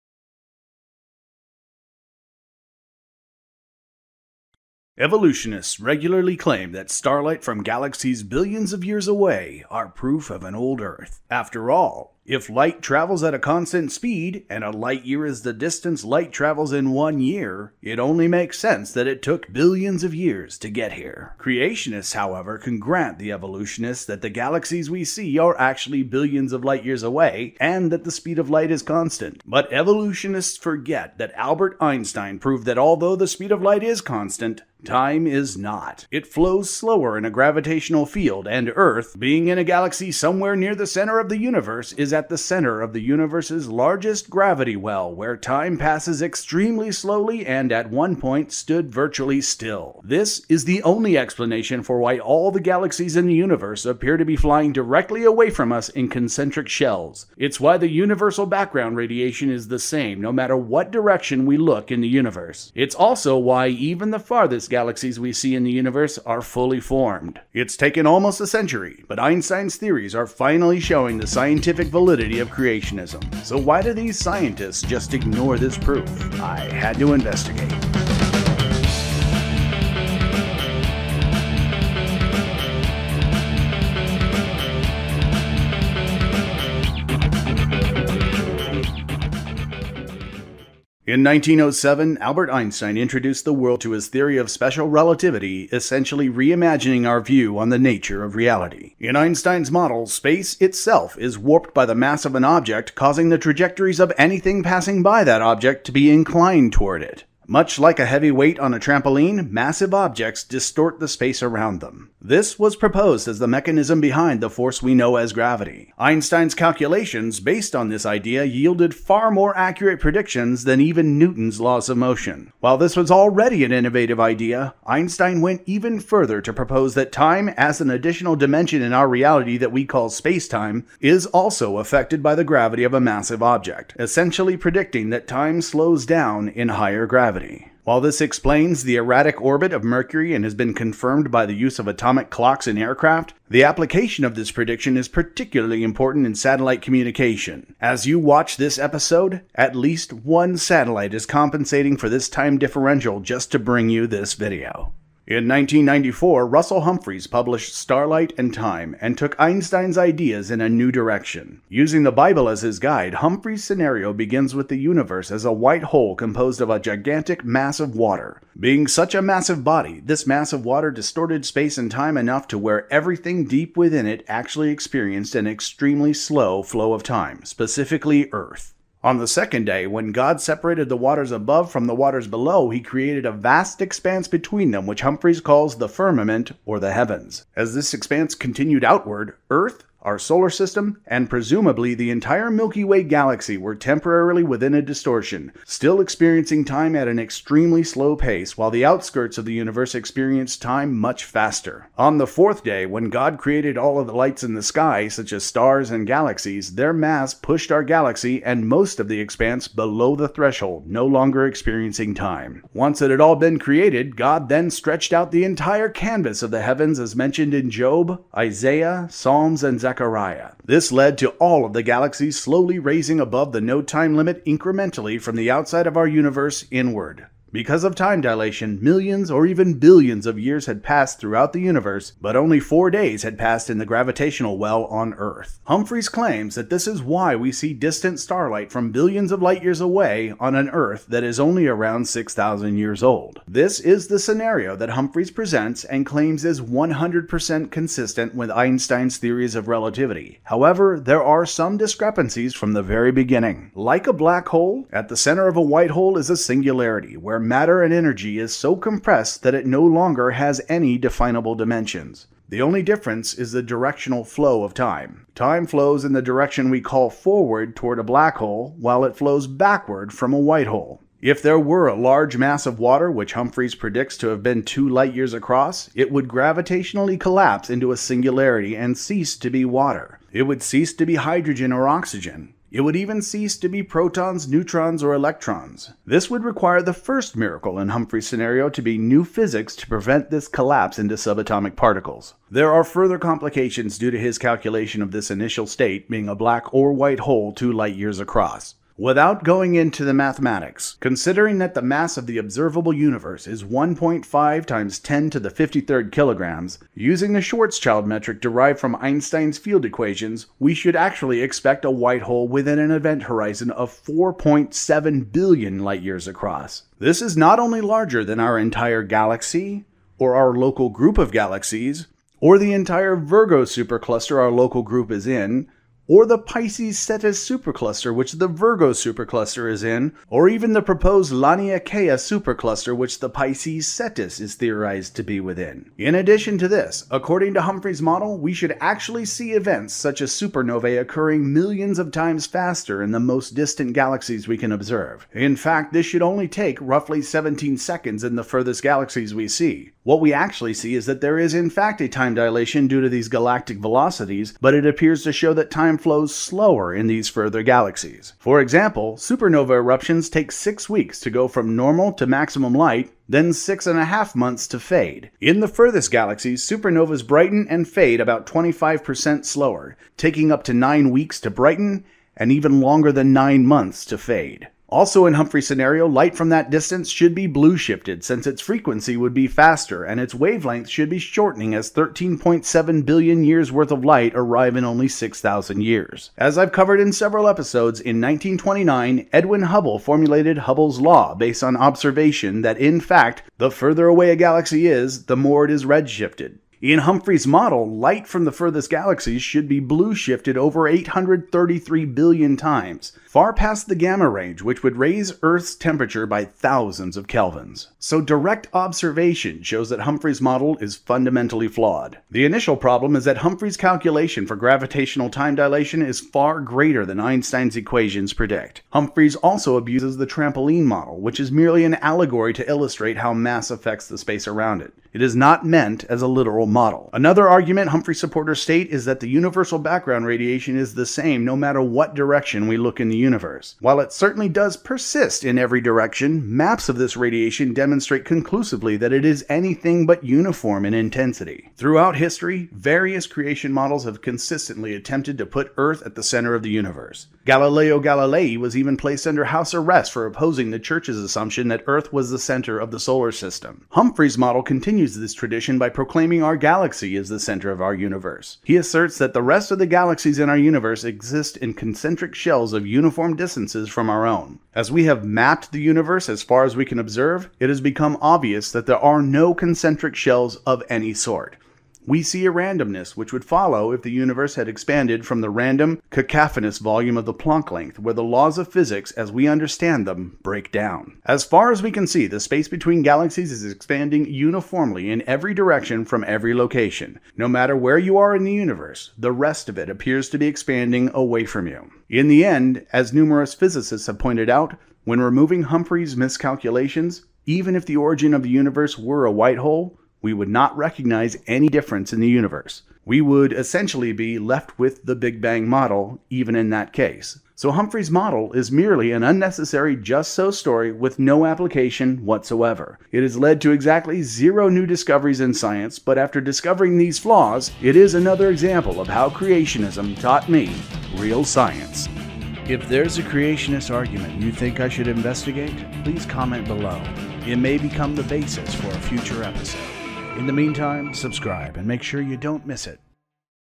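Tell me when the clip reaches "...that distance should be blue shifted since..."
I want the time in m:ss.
6:16.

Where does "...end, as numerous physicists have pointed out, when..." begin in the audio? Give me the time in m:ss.
8:12.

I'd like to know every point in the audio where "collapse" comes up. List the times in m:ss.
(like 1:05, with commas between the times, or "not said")
4:37, 4:50.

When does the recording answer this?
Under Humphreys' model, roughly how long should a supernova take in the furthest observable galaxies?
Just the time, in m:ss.
5:47.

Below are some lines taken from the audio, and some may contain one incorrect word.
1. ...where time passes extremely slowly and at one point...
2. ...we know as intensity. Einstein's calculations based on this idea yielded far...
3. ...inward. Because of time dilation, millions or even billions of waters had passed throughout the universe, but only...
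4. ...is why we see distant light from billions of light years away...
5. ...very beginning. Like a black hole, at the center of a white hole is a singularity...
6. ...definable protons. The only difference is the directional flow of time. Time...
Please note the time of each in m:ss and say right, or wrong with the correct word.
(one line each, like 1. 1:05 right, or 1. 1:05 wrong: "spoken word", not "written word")
1. 0:45 right
2. 1:54 wrong: "gravity", not "intensity"
3. 3:46 wrong: "years", not "waters"
4. 3:56 wrong: "starlight", not "light"
5. 4:12 right
6. 4:20 wrong: "dimensions", not "protons".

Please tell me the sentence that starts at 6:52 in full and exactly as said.
The initial problem is that Humphrey's calculation for gravitational time dilation is far greater than Einstein's equations predict.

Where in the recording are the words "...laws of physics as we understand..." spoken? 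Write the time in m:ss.
7:58.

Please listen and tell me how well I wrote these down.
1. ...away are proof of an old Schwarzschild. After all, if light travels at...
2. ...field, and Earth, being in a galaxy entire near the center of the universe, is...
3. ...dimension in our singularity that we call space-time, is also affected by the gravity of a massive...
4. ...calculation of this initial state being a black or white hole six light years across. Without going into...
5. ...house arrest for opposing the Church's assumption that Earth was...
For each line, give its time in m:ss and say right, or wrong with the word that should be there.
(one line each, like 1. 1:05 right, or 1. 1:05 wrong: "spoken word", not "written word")
1. 0:09 wrong: "Earth", not "Schwarzschild"
2. 0:38 wrong: "somewhere", not "entire"
3. 2:08 wrong: "reality", not "singularity"
4. 4:54 wrong: "two", not "six"
5. 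7:29 right.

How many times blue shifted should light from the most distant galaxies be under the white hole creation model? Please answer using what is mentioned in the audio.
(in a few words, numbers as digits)
833 billion.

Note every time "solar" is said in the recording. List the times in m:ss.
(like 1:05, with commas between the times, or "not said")
3:10, 7:32.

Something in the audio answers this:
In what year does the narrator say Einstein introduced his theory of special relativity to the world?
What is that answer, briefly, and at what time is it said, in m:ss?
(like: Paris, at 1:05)
1907, at 1:31.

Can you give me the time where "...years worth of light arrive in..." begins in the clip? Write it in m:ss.
6:23.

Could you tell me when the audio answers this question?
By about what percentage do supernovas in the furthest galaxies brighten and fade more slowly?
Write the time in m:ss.
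6:08.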